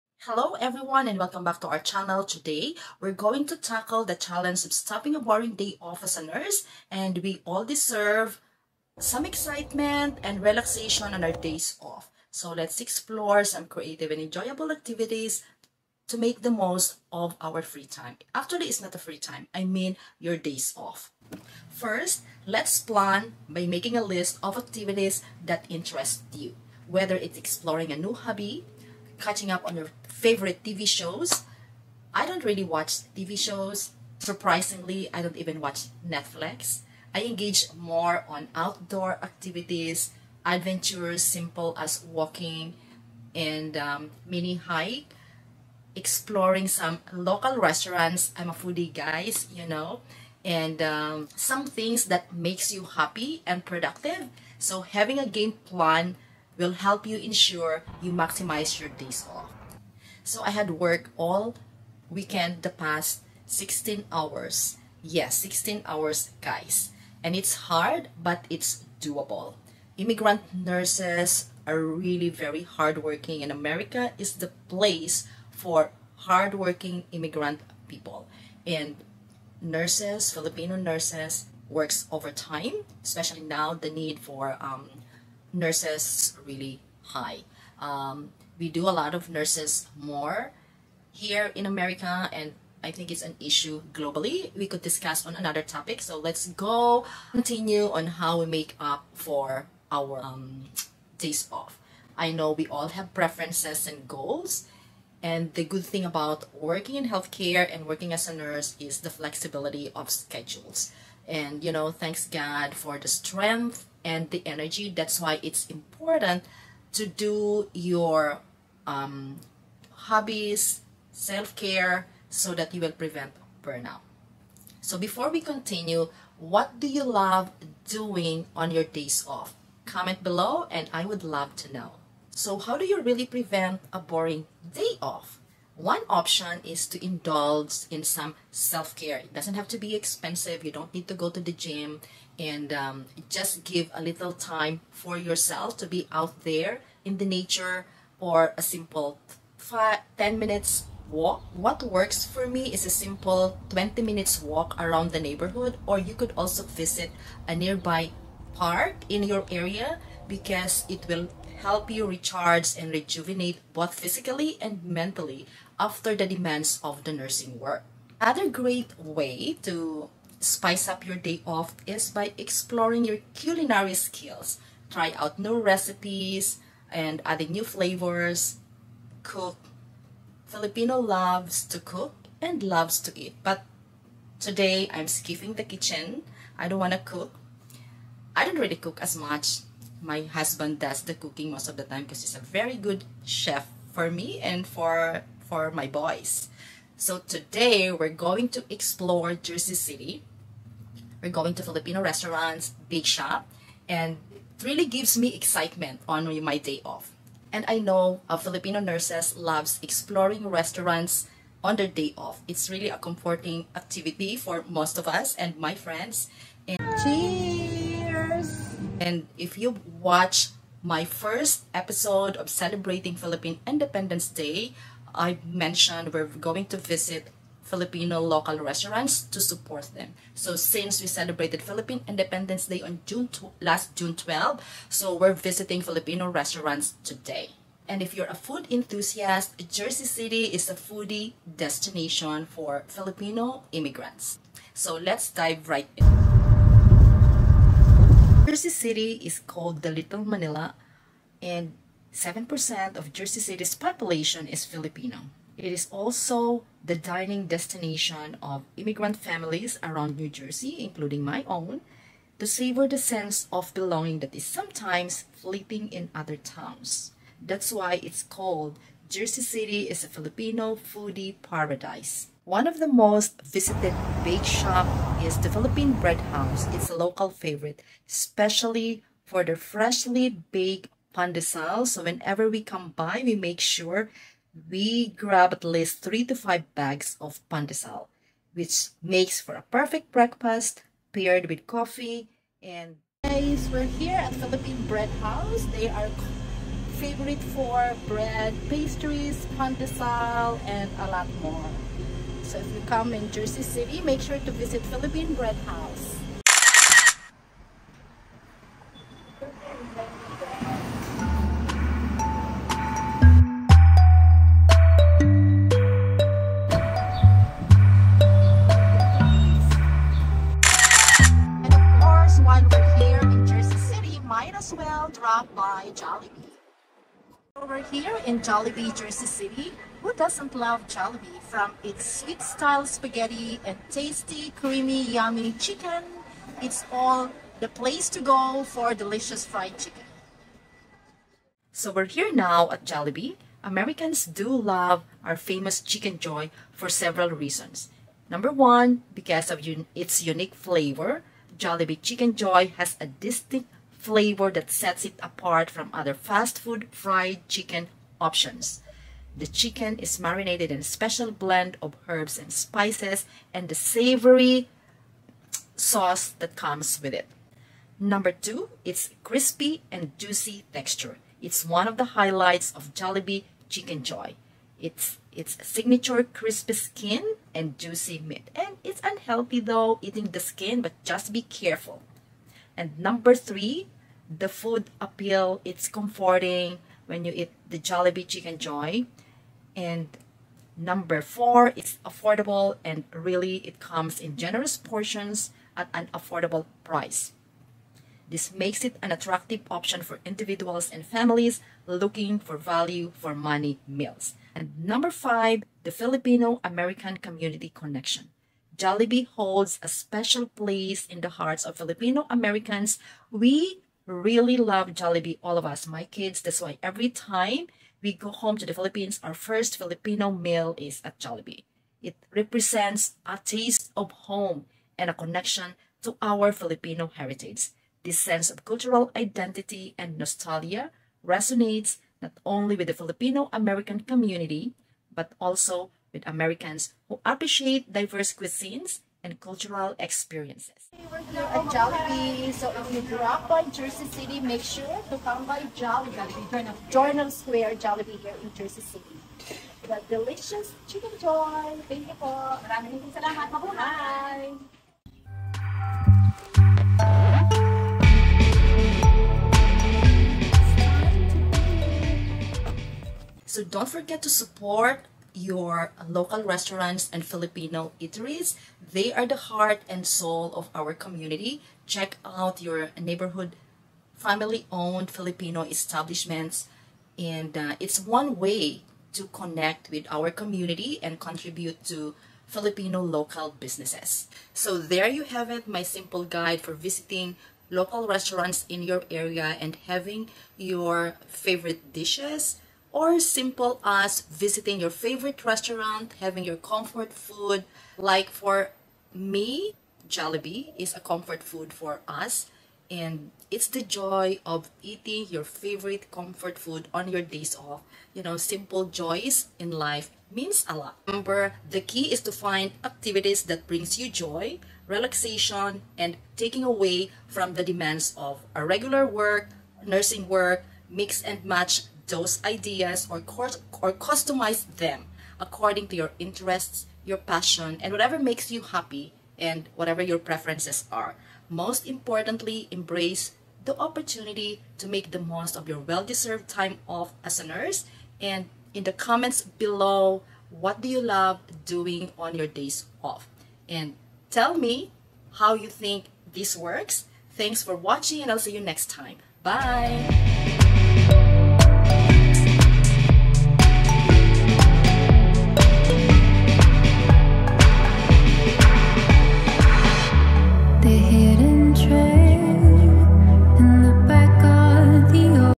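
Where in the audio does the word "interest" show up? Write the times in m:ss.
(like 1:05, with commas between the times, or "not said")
0:25, 8:46.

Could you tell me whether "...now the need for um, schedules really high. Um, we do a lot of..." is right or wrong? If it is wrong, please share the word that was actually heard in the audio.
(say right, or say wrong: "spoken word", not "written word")
wrong: "nurses", not "schedules".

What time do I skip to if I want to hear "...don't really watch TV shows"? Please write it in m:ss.
0:32.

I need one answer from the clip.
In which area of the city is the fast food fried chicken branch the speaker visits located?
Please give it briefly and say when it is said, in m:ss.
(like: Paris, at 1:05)
Journal Square, at 7:26.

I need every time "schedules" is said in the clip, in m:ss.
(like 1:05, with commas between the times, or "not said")
1:50.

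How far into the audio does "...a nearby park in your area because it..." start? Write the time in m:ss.
2:37.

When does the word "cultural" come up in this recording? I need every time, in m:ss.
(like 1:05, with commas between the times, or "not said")
7:08, 7:19.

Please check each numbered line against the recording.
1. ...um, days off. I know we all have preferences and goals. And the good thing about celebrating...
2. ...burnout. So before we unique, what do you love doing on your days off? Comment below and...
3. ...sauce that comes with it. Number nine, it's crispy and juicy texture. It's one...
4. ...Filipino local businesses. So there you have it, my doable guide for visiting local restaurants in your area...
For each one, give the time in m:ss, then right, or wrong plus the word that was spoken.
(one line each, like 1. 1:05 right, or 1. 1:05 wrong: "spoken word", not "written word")
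1. 1:40 wrong: "working", not "celebrating"
2. 2:03 wrong: "continue", not "unique"
3. 6:05 wrong: "two", not "nine"
4. 8:02 wrong: "simple", not "doable".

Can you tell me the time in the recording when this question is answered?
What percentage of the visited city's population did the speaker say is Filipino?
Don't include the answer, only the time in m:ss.
4:12.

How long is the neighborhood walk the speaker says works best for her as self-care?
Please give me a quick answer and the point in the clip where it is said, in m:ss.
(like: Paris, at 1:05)
20 minutes, at 2:33.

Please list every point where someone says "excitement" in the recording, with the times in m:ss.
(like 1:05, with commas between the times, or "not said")
0:09, 3:25.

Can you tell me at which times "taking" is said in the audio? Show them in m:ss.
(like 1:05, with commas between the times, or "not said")
8:36.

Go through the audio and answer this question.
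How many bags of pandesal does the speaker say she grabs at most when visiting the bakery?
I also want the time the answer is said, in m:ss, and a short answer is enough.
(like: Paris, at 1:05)
5, at 4:46.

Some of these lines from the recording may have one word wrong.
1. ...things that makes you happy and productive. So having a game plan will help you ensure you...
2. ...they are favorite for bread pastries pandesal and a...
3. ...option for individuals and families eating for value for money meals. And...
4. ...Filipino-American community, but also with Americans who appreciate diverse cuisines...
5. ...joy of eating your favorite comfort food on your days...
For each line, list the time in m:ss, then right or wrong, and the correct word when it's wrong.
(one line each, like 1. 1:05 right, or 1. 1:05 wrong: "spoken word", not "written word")
1. 0:51 right
2. 4:55 right
3. 6:39 wrong: "looking", not "eating"
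4. 7:12 right
5. 8:23 right.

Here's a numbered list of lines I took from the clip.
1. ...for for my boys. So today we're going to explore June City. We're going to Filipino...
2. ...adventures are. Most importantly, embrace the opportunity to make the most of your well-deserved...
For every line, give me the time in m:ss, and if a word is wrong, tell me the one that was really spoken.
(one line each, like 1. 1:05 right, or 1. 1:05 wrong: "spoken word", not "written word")
1. 3:14 wrong: "Jersey", not "June"
2. 8:50 wrong: "preferences", not "adventures".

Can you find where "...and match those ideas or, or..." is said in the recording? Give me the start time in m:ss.
8:41.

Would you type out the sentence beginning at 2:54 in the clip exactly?
Try out new recipes and adding new flavors.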